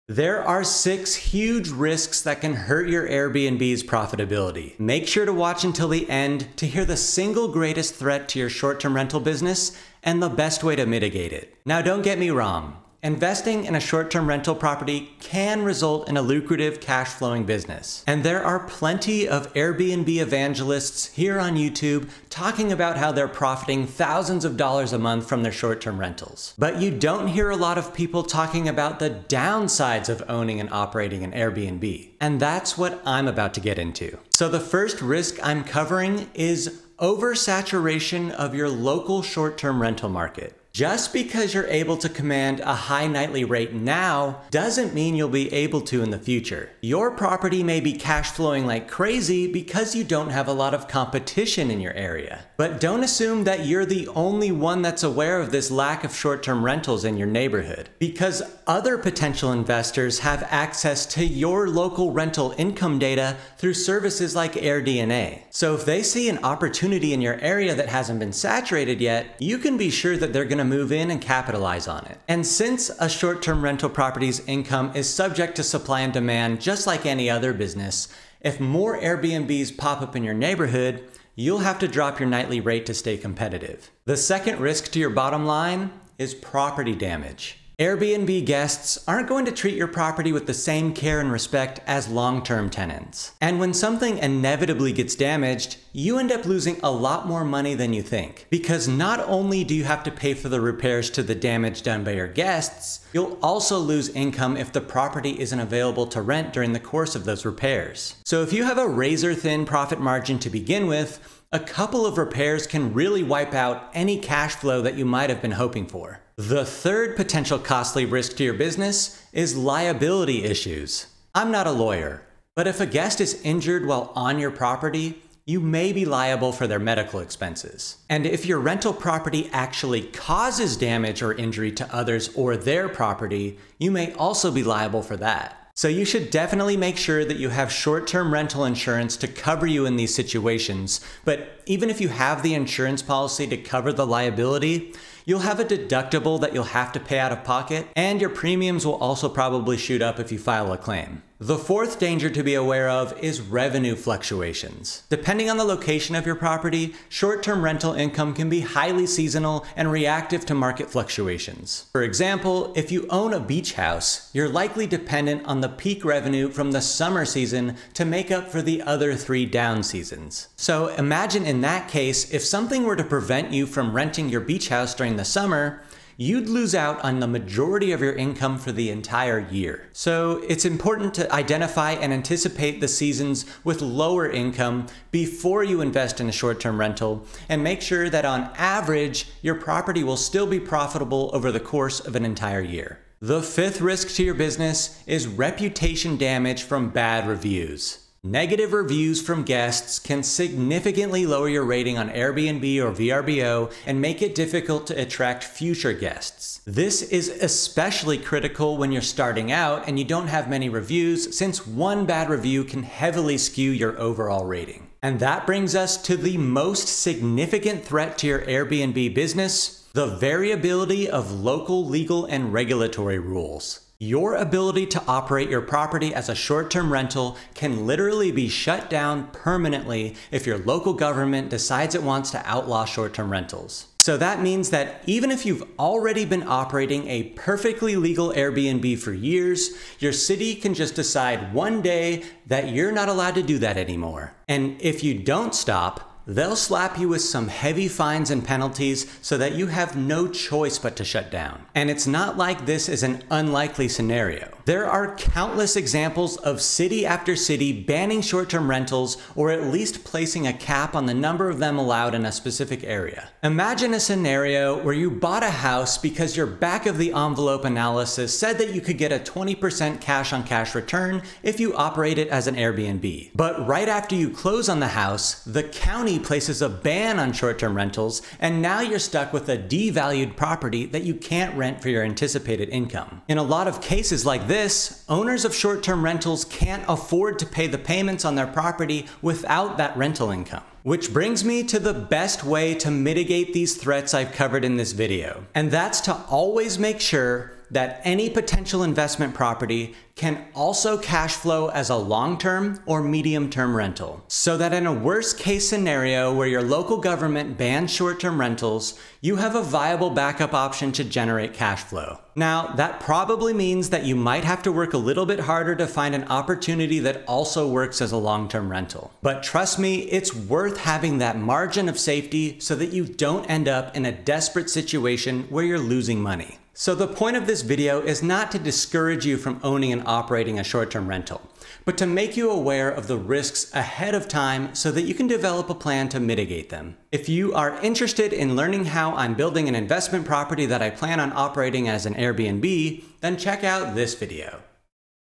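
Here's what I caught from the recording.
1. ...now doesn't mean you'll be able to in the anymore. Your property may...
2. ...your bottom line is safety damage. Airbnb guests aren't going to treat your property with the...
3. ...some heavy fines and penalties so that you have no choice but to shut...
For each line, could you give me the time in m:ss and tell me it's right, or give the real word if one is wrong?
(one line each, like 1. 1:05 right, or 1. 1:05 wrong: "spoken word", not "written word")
1. 0:43 wrong: "future", not "anymore"
2. 1:24 wrong: "property", not "safety"
3. 4:07 right.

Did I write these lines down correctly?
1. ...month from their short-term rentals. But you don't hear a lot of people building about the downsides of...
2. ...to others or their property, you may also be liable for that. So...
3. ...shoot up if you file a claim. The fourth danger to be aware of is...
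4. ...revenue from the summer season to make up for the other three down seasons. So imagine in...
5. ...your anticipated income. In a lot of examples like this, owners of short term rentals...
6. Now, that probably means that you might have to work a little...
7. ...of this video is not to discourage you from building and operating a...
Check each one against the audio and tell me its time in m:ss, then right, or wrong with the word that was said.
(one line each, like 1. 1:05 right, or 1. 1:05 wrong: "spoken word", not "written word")
1. 0:24 wrong: "talking", not "building"
2. 2:11 right
3. 2:29 right
4. 2:46 right
5. 4:41 wrong: "cases", not "examples"
6. 5:12 right
7. 5:27 wrong: "owning", not "building".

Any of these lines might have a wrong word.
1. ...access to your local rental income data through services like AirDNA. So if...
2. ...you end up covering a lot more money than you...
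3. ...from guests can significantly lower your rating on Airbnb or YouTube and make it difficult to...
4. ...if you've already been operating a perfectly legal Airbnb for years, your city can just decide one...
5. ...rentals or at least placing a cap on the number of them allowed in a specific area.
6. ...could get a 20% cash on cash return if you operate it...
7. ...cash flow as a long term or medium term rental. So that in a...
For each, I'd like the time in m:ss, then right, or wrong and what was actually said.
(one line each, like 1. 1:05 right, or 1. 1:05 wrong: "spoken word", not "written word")
1. 1:00 right
2. 1:35 wrong: "losing", not "covering"
3. 3:19 wrong: "VRBO", not "YouTube"
4. 3:55 right
5. 4:18 right
6. 4:28 right
7. 5:00 right.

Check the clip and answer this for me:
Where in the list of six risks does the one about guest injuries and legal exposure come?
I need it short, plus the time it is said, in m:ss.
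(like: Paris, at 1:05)
Third, at 1:56.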